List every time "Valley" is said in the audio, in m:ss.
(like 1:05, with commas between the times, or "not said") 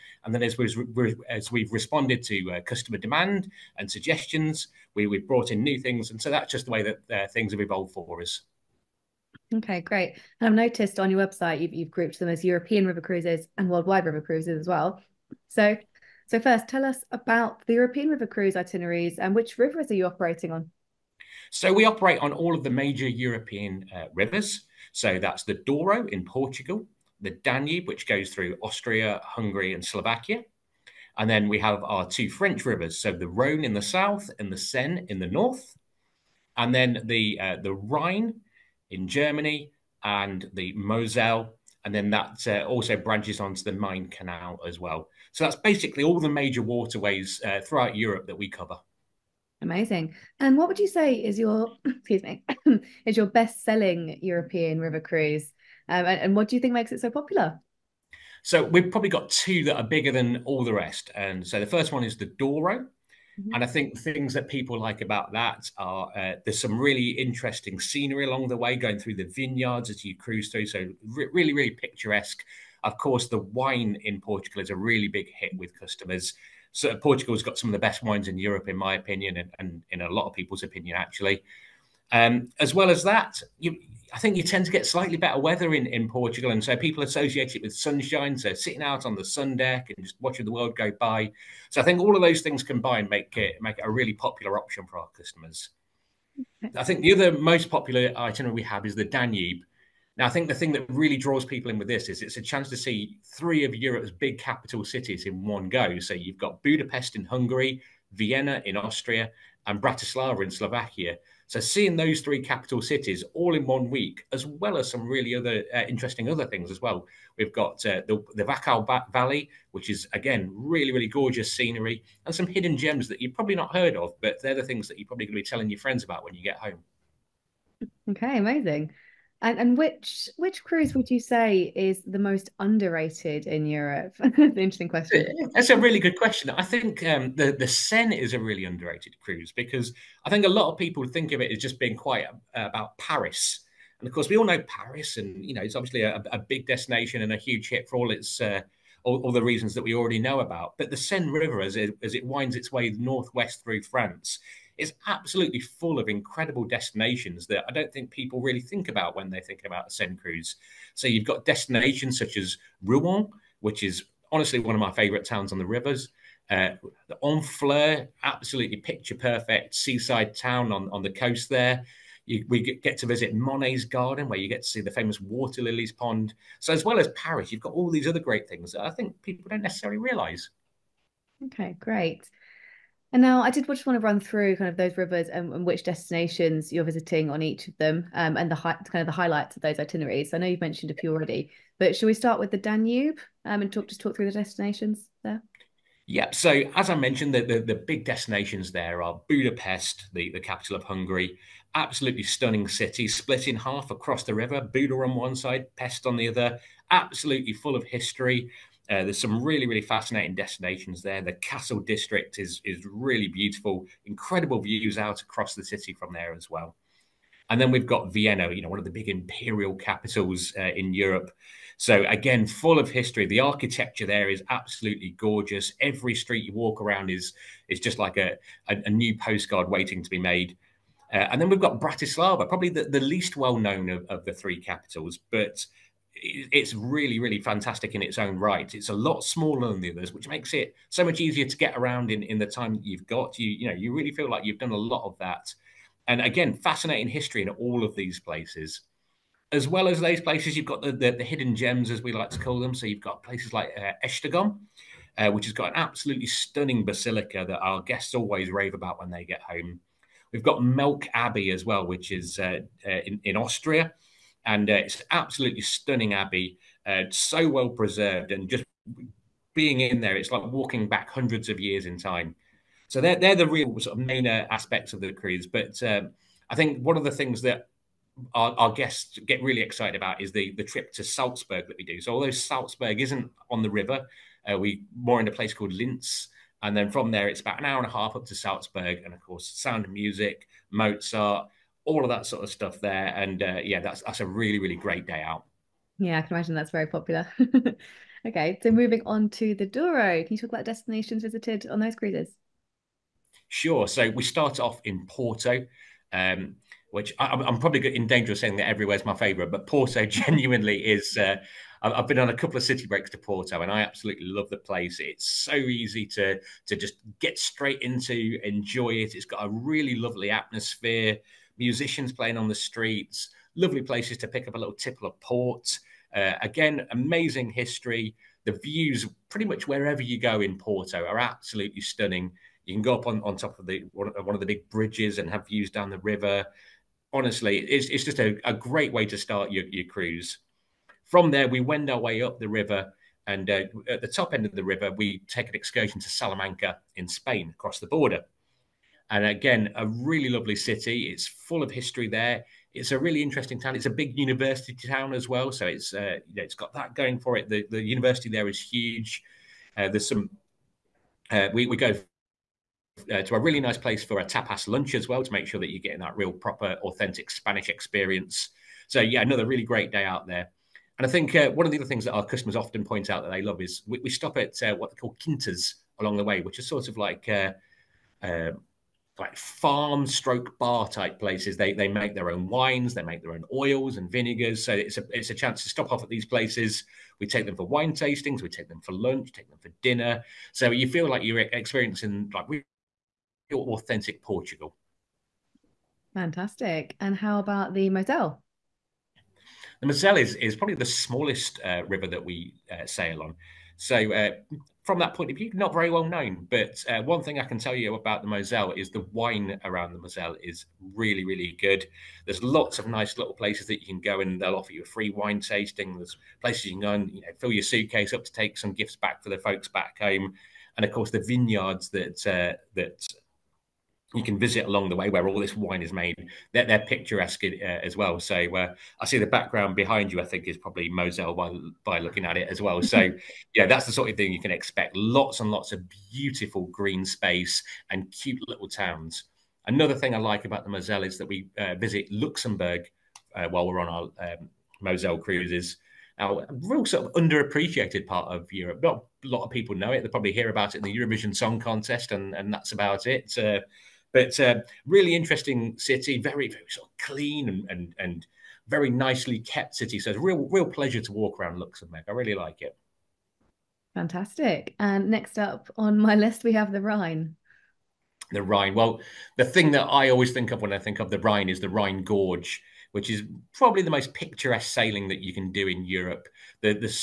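1:59.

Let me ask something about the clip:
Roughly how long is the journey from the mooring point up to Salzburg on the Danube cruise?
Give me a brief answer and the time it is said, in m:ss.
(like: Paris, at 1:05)
an hour and a half, at 4:47.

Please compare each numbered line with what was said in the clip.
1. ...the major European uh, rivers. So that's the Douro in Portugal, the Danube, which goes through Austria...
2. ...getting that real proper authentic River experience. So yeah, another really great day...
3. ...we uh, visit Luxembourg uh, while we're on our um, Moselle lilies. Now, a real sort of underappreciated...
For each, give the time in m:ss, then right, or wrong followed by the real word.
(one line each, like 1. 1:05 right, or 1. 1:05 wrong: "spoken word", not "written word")
1. 0:22 right
2. 6:05 wrong: "Spanish", not "River"
3. 7:21 wrong: "cruises", not "lilies".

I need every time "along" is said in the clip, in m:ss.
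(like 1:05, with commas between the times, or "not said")
1:08, 6:16, 7:04.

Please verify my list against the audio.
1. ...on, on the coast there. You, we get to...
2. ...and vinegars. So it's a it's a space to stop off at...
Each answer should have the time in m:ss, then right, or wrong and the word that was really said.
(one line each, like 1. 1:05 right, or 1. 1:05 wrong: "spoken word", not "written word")
1. 2:50 right
2. 6:23 wrong: "chance", not "space".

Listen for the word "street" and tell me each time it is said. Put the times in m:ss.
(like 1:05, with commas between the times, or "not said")
3:46, 5:22.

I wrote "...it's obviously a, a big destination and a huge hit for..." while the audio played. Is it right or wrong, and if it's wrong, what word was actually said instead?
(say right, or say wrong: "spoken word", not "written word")
right.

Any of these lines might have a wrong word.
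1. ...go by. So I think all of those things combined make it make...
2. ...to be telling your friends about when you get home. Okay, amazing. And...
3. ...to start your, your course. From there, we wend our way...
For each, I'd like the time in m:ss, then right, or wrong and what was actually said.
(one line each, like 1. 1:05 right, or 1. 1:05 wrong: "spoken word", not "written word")
1. 1:30 right
2. 2:05 right
3. 5:39 wrong: "cruise", not "course".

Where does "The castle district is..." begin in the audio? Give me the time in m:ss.
3:31.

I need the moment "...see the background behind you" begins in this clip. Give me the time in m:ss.
7:09.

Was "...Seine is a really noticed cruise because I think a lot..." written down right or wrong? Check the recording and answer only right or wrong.
wrong.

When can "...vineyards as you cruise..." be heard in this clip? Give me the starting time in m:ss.
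1:09.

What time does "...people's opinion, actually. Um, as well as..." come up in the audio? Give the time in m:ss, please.
1:20.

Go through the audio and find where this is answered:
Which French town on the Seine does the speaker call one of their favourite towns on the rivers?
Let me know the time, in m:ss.
2:42.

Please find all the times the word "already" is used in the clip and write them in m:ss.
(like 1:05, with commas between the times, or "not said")
2:29, 3:11.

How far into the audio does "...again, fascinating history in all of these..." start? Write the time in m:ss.
4:06.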